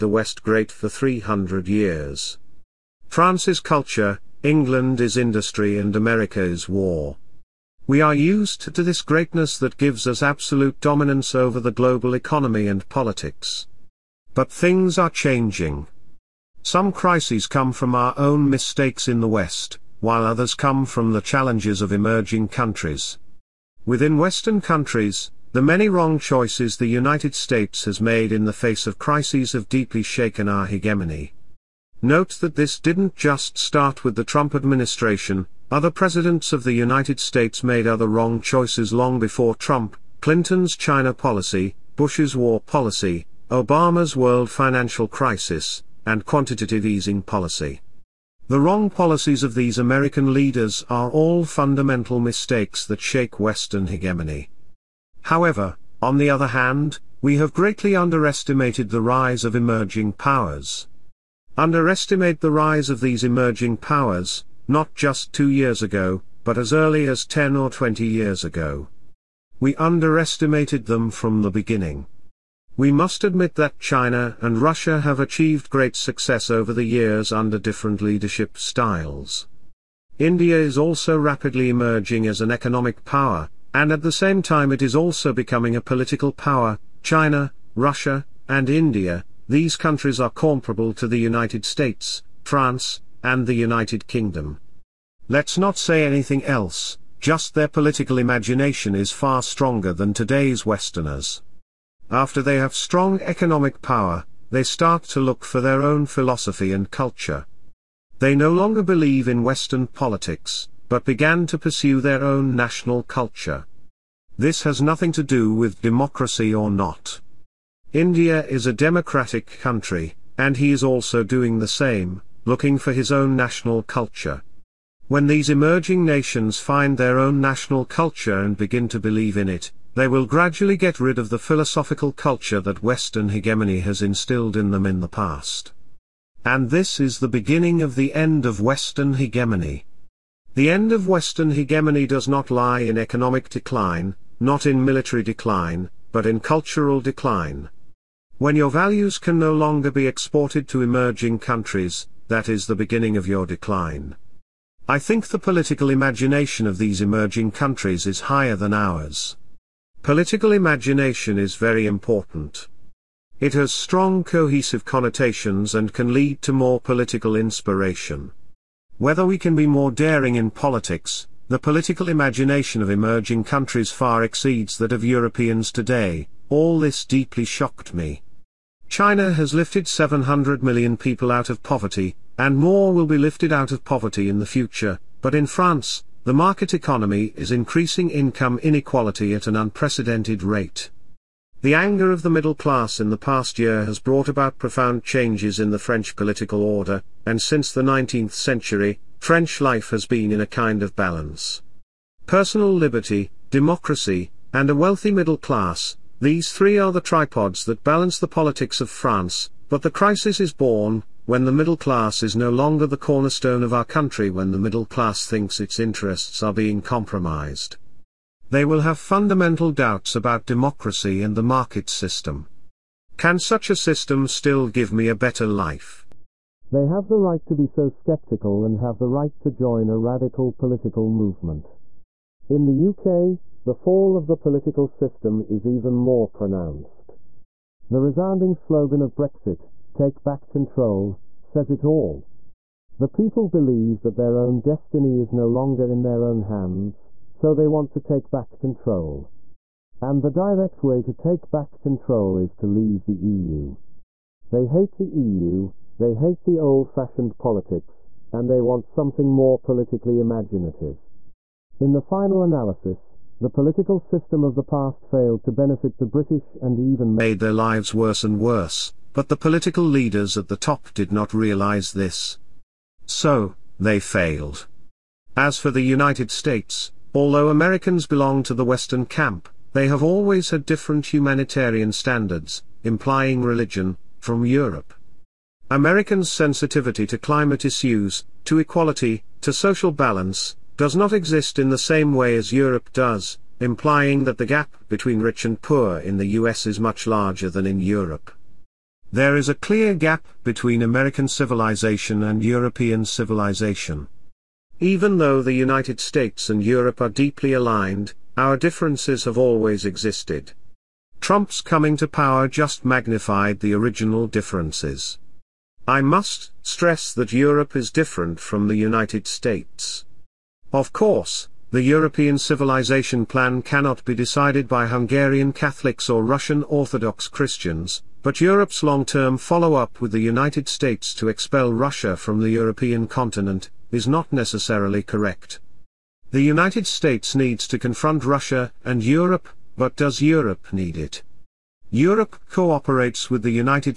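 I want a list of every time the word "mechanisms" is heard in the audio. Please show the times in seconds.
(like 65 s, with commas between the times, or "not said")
not said.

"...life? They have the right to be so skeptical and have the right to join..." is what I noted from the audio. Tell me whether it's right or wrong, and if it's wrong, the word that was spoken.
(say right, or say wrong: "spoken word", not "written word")
right.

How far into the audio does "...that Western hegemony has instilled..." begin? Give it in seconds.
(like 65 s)
132 s.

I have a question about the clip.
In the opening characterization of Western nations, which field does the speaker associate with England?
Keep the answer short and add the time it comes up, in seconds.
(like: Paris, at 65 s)
industry, at 4 s.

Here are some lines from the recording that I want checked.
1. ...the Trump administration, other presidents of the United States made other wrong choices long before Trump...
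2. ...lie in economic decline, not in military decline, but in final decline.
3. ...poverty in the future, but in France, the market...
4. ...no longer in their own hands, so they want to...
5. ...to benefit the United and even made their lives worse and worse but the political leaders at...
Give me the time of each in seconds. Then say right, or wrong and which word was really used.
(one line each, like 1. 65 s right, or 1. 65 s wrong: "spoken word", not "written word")
1. 34 s right
2. 142 s wrong: "cultural", not "final"
3. 183 s right
4. 245 s right
5. 265 s wrong: "British", not "United".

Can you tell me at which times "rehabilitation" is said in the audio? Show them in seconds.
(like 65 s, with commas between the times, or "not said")
not said.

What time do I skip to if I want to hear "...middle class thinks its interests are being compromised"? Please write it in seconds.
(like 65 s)
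214 s.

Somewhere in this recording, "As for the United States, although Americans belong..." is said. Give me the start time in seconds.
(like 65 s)
275 s.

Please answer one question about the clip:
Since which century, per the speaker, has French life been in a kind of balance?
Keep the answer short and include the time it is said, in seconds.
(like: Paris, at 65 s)
19th century, at 197 s.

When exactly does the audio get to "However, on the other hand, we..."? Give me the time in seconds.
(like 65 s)
55 s.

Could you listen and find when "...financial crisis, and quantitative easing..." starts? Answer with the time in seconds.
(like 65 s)
44 s.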